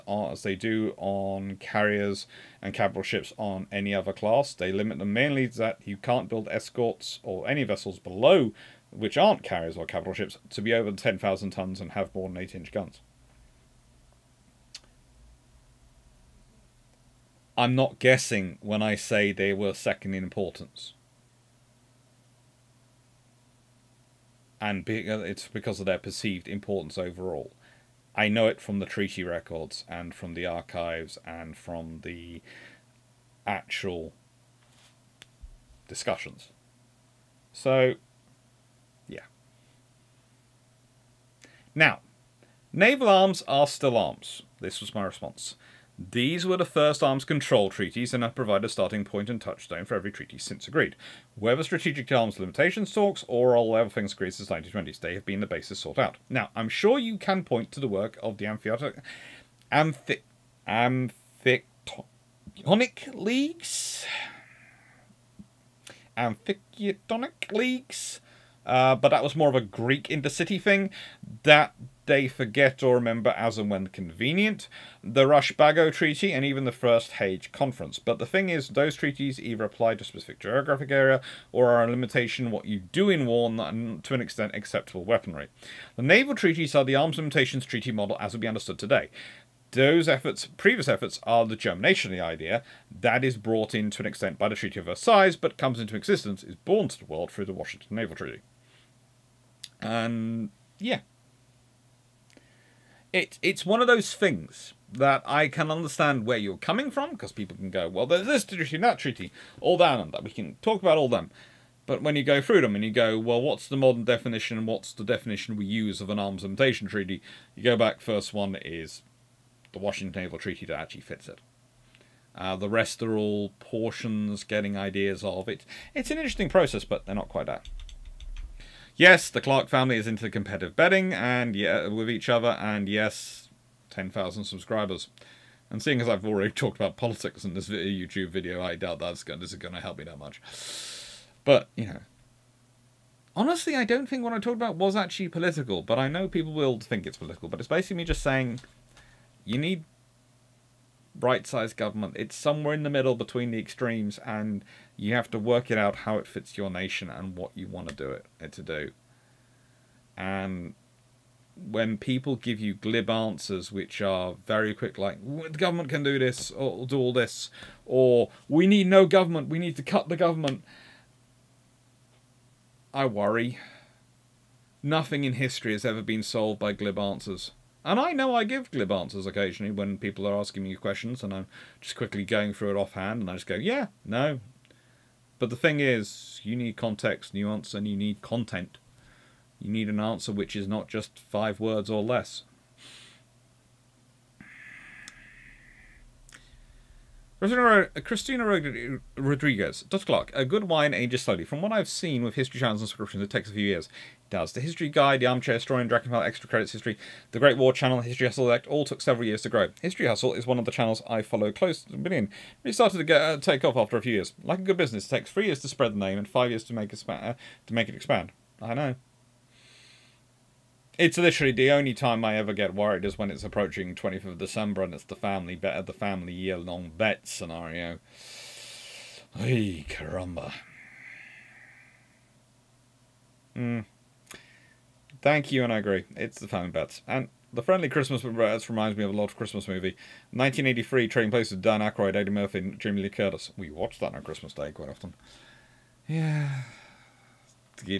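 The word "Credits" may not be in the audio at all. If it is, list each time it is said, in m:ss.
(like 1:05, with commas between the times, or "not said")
3:26.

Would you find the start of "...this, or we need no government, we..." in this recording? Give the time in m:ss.
2:47.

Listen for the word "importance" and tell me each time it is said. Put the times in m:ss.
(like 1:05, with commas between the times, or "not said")
0:20, 0:26.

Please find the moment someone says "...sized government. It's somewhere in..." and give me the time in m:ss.
2:31.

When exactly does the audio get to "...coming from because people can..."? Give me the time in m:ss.
1:46.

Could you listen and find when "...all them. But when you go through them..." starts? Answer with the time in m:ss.
1:50.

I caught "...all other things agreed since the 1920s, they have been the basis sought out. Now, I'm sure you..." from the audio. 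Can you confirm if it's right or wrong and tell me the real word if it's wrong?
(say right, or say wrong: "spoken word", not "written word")
right.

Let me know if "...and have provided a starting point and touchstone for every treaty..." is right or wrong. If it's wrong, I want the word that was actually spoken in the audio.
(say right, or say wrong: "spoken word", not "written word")
right.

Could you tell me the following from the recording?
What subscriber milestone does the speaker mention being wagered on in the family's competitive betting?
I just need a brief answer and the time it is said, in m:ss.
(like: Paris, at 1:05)
10,000 subscribers, at 2:13.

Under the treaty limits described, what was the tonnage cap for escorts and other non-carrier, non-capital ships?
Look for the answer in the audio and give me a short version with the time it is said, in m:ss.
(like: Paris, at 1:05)
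10,000 tons, at 0:10.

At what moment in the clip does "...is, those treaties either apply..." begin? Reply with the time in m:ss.
1:18.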